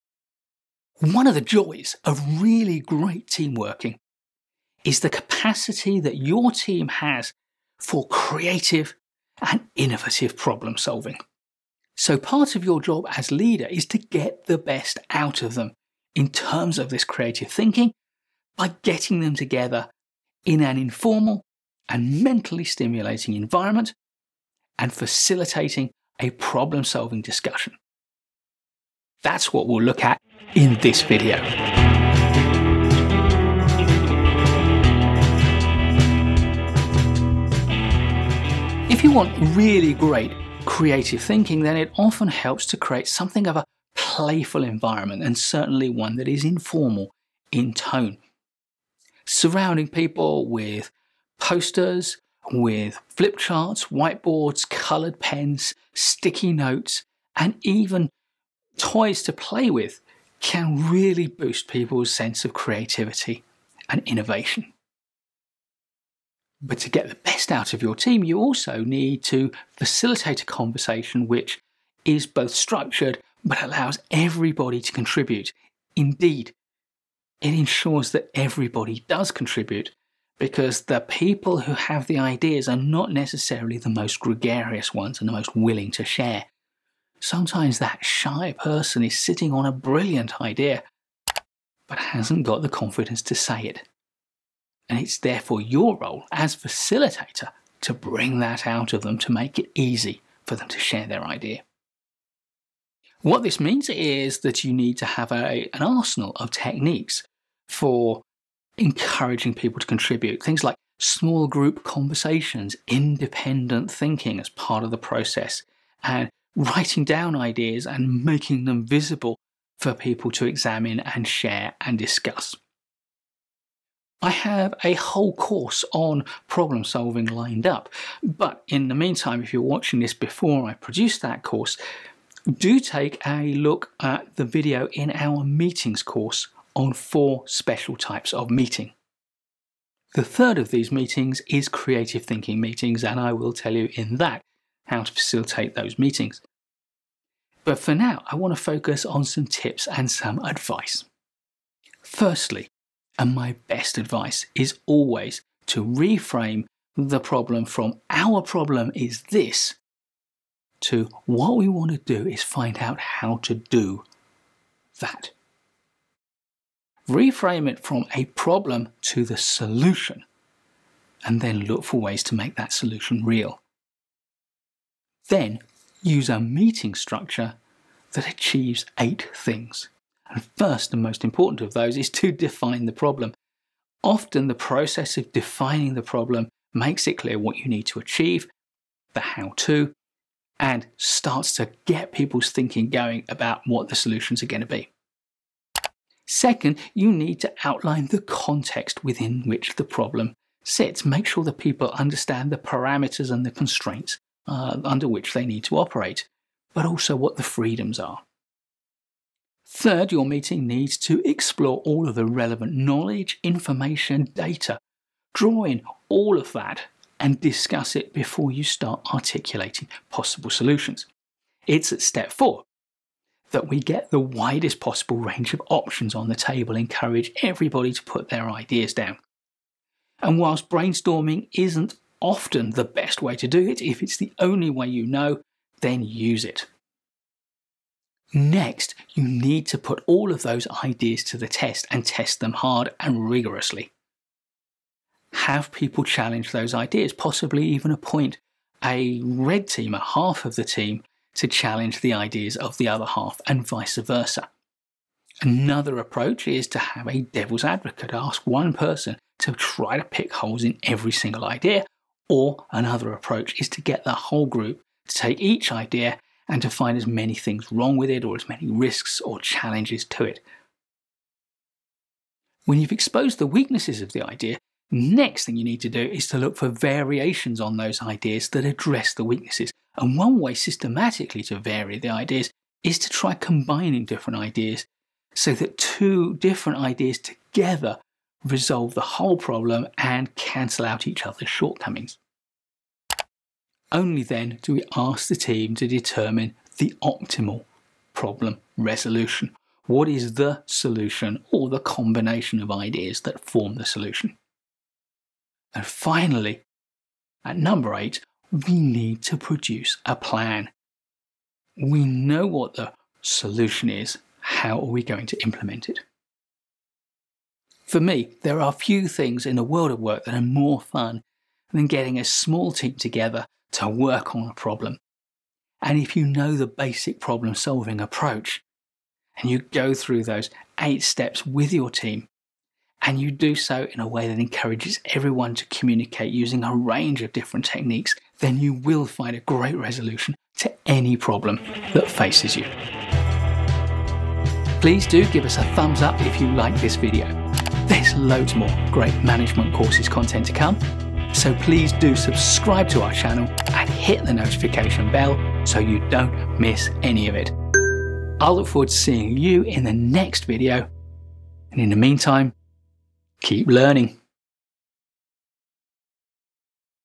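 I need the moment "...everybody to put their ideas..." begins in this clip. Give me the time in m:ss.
3:47.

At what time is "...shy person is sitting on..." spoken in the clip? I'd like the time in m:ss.
1:28.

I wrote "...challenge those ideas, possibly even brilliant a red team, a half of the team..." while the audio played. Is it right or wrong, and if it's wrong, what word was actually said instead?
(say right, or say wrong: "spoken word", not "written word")
wrong: "appoint", not "brilliant".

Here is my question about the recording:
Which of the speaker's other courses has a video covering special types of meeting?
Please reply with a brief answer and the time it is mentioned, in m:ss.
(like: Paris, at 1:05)
meetings course, at 2:15.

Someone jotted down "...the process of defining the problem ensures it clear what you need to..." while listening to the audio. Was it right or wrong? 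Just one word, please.
wrong.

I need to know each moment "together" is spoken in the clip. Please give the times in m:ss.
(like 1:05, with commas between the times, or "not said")
0:19, 4:47, 5:22.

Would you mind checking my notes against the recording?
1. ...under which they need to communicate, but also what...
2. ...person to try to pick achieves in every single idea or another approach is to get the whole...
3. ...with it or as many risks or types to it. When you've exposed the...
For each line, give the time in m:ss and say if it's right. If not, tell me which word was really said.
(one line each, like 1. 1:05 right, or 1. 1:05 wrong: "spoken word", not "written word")
1. 3:24 wrong: "operate", not "communicate"
2. 4:18 wrong: "holes", not "achieves"
3. 4:27 wrong: "challenges", not "types".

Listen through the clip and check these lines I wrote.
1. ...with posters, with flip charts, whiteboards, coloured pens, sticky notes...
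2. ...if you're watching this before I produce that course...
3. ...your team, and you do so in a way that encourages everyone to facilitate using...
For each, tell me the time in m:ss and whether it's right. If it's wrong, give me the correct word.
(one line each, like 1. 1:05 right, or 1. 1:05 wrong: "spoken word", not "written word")
1. 0:50 right
2. 2:09 right
3. 5:31 wrong: "communicate", not "facilitate".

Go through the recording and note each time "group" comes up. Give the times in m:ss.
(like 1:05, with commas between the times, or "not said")
1:51, 4:24.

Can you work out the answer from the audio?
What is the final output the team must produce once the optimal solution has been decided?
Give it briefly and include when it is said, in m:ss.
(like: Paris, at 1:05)
a plan, at 5:10.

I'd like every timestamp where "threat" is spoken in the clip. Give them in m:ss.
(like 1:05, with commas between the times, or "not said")
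not said.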